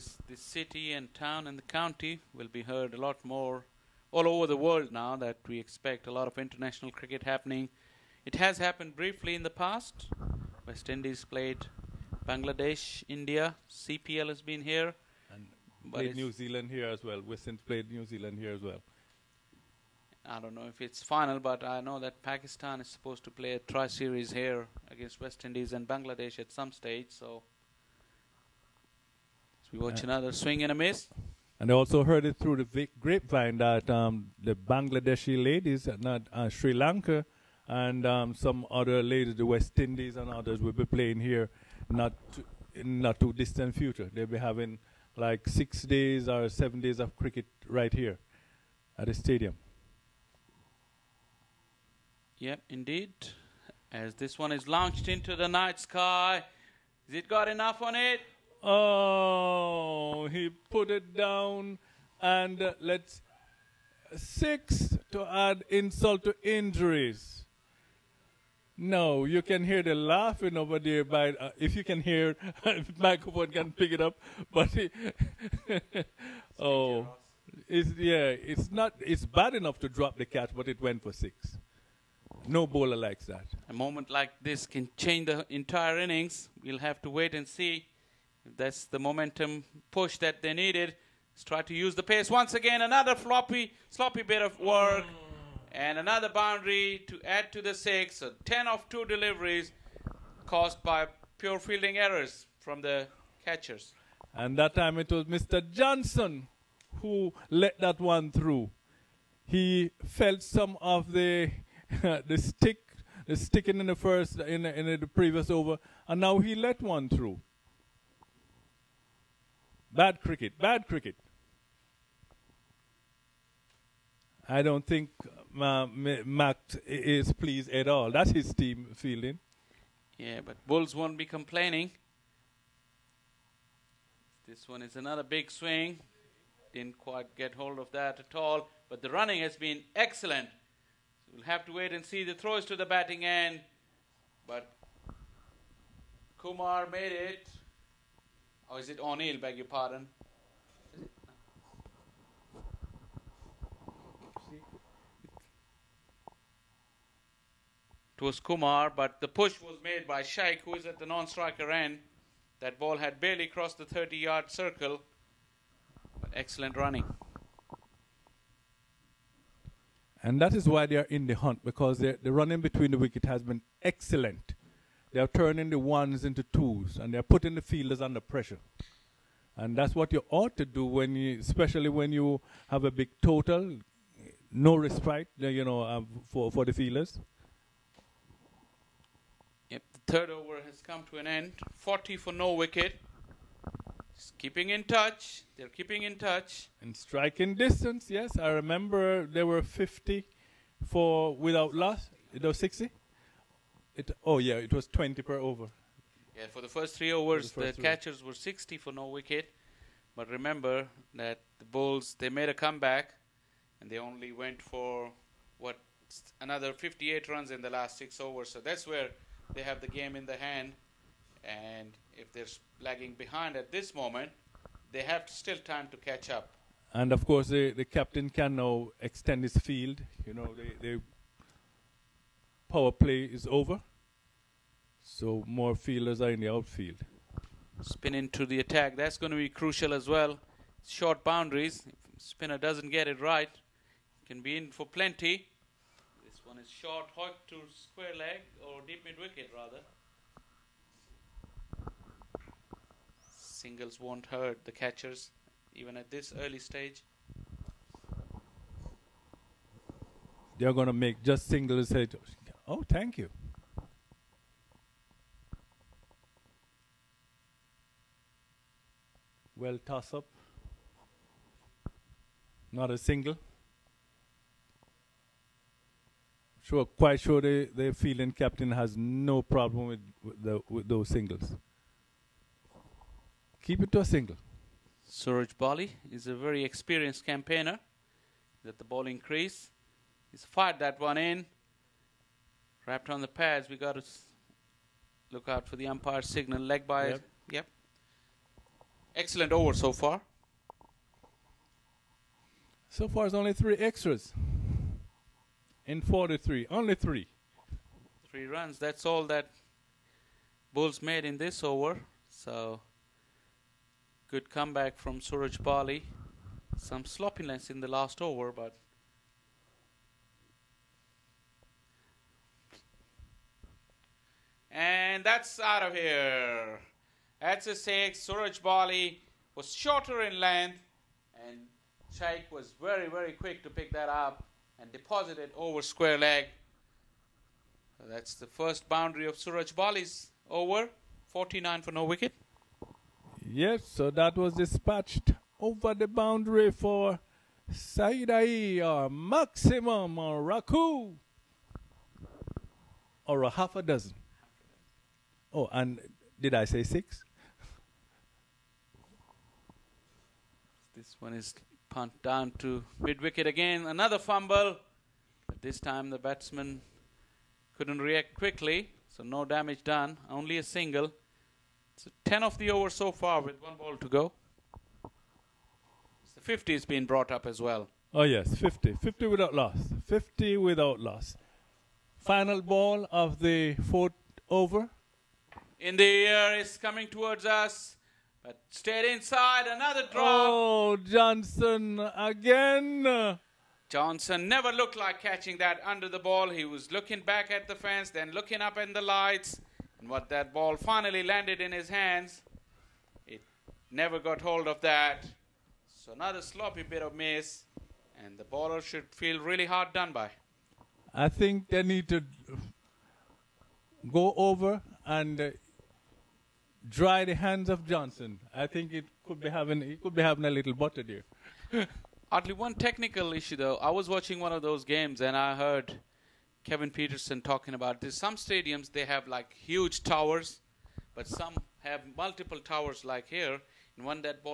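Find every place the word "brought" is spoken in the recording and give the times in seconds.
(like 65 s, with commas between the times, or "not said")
377 s.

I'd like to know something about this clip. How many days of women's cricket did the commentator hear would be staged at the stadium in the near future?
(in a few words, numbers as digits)
6 or 7.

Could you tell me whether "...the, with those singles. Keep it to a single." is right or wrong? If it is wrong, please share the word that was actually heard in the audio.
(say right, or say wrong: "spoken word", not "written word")
right.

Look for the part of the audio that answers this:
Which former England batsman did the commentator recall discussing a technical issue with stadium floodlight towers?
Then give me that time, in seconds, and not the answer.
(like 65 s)
426 s.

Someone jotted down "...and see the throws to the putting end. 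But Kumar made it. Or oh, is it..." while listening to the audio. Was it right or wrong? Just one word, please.
wrong.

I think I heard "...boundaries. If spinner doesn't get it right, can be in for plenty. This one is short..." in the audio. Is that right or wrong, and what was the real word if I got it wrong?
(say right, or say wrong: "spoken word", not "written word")
right.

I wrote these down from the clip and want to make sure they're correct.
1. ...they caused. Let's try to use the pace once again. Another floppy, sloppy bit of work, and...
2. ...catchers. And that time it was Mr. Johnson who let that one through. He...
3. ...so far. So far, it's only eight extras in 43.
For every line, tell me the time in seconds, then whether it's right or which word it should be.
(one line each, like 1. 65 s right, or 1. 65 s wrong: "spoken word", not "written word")
1. 90 s wrong: "needed", not "caused"
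2. 103 s right
3. 299 s wrong: "three", not "eight".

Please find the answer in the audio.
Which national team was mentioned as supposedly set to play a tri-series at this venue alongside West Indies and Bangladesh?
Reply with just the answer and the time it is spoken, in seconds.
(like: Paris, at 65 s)
Pakistan, at 22 s.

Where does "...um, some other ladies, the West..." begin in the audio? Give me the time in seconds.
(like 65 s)
38 s.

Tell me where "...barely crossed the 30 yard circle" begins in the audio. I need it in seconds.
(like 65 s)
163 s.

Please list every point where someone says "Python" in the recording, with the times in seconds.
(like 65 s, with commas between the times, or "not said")
not said.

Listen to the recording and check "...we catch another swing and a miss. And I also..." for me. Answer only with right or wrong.
wrong.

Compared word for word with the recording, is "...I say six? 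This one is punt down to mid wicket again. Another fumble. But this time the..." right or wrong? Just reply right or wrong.
right.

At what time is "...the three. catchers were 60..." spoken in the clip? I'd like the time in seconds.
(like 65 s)
207 s.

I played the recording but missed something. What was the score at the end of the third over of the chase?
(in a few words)
40 for no wicket.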